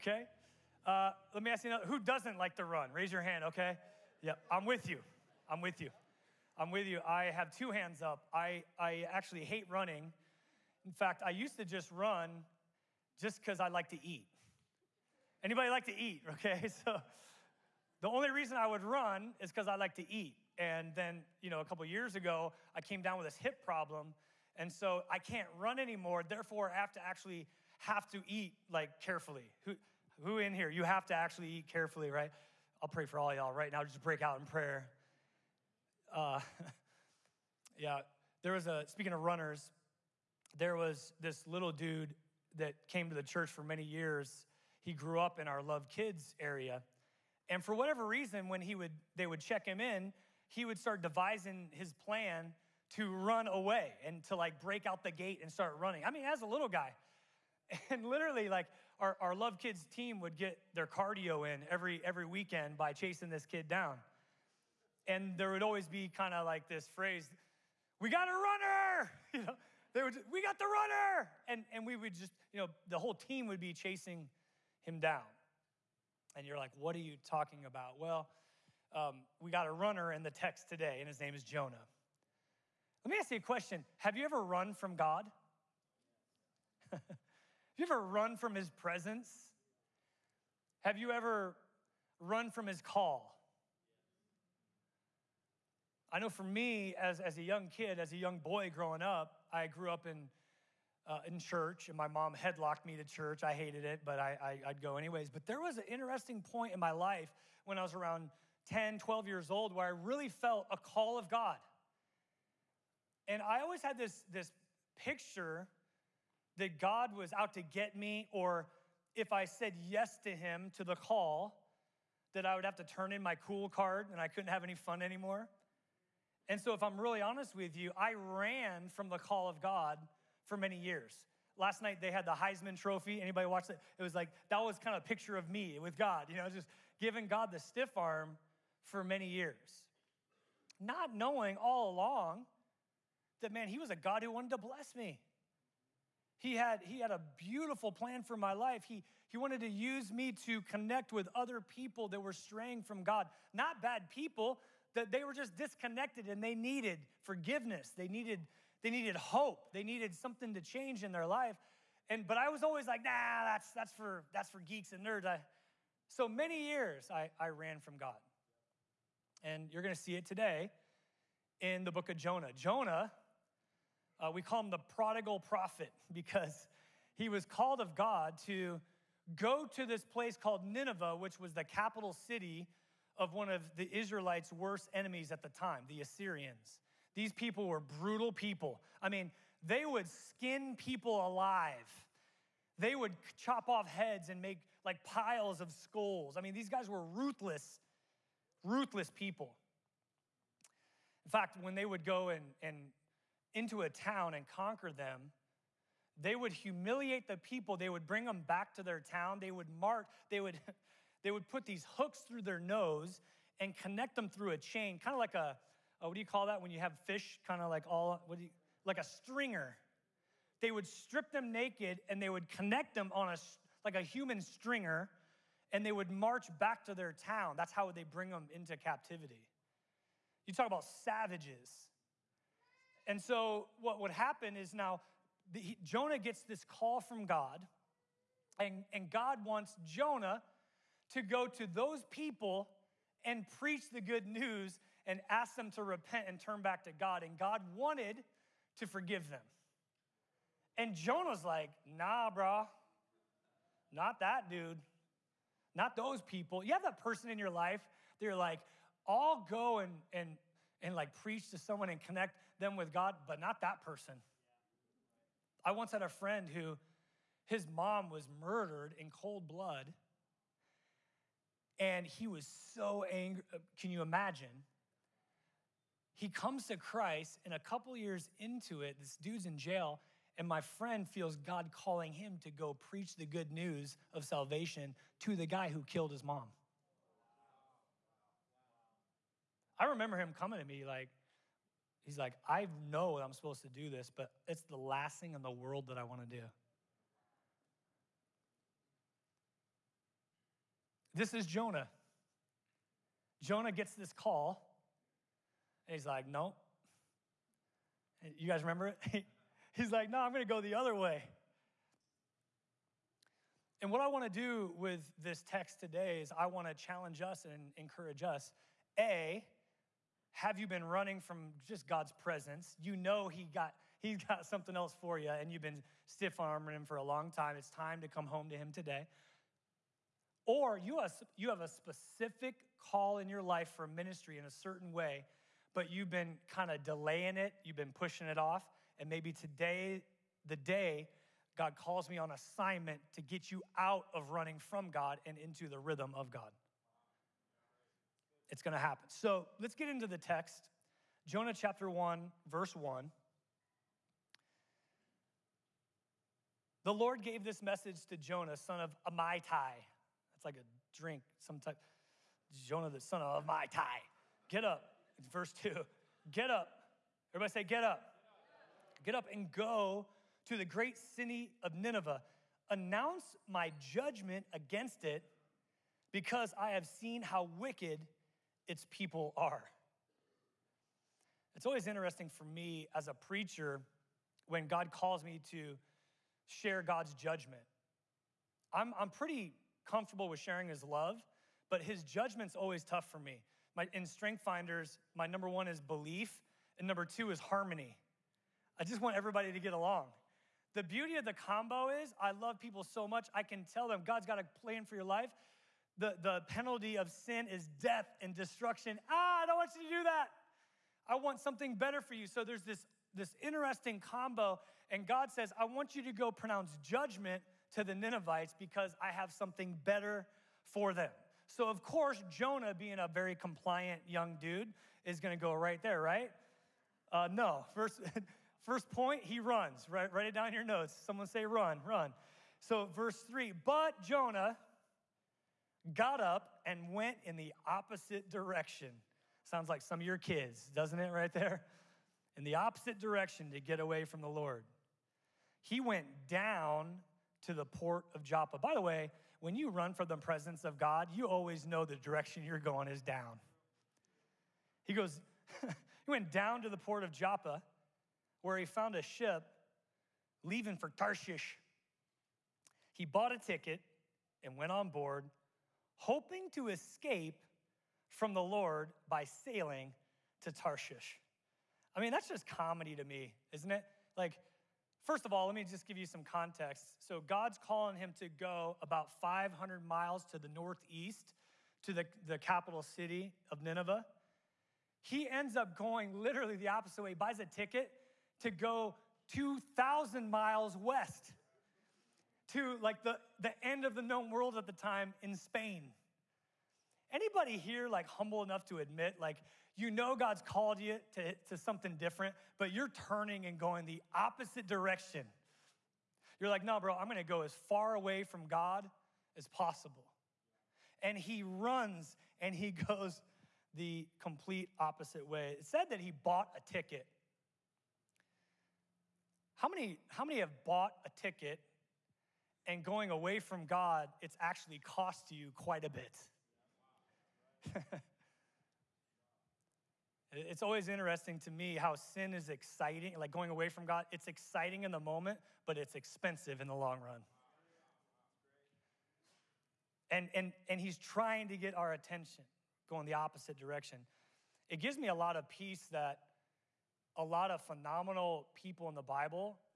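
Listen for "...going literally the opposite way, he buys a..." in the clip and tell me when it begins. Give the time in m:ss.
8:05.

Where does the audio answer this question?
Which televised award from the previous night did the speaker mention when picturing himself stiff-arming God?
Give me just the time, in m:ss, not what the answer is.
2:12.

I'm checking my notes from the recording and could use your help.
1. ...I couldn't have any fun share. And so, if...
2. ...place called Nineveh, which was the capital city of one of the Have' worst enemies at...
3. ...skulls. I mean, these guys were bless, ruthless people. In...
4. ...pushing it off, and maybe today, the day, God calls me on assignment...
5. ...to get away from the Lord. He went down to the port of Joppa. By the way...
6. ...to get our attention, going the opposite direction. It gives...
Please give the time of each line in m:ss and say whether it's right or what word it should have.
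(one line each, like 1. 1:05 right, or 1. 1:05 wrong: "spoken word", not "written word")
1. 2:04 wrong: "anymore", not "share"
2. 3:00 wrong: "Israelites", not "Have"
3. 3:15 wrong: "ruthless", not "bless"
4. 5:37 right
5. 7:23 right
6. 9:01 right.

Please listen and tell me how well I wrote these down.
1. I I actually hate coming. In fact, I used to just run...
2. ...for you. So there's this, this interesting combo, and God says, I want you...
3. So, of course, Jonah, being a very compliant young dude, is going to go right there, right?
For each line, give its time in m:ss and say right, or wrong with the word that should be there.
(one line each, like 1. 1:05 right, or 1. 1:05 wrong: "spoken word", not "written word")
1. 0:08 wrong: "running", not "coming"
2. 6:52 right
3. 7:01 right.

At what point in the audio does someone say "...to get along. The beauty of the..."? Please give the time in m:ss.
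6:39.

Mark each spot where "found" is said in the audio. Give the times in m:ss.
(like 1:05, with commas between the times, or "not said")
7:38.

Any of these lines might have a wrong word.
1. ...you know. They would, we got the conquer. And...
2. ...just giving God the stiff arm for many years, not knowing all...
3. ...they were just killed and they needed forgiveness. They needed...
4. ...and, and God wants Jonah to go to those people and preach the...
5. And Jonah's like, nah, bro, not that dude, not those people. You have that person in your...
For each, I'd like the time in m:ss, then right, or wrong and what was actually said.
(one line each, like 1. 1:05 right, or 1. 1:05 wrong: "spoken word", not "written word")
1. 1:09 wrong: "runner", not "conquer"
2. 2:16 right
3. 2:35 wrong: "disconnected", not "killed"
4. 3:58 right
5. 4:10 right.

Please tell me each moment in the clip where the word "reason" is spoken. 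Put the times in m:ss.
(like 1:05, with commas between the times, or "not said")
0:18, 0:48.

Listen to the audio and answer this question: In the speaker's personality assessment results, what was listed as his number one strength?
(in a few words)
belief.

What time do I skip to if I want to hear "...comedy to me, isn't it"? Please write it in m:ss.
7:52.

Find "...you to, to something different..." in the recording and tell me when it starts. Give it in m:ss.
8:20.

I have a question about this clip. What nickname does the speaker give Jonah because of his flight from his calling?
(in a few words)
the prodigal prophet.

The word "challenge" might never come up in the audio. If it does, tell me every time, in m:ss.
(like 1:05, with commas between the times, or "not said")
5:16.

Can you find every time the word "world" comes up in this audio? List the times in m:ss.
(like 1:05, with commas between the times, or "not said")
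4:55, 8:14.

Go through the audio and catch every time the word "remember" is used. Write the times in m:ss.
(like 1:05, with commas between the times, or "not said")
4:49, 5:08.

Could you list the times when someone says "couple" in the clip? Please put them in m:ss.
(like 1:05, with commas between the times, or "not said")
0:21, 4:37.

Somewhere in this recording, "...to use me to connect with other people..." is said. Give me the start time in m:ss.
2:29.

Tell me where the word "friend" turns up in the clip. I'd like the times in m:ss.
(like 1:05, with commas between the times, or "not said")
4:26, 4:40.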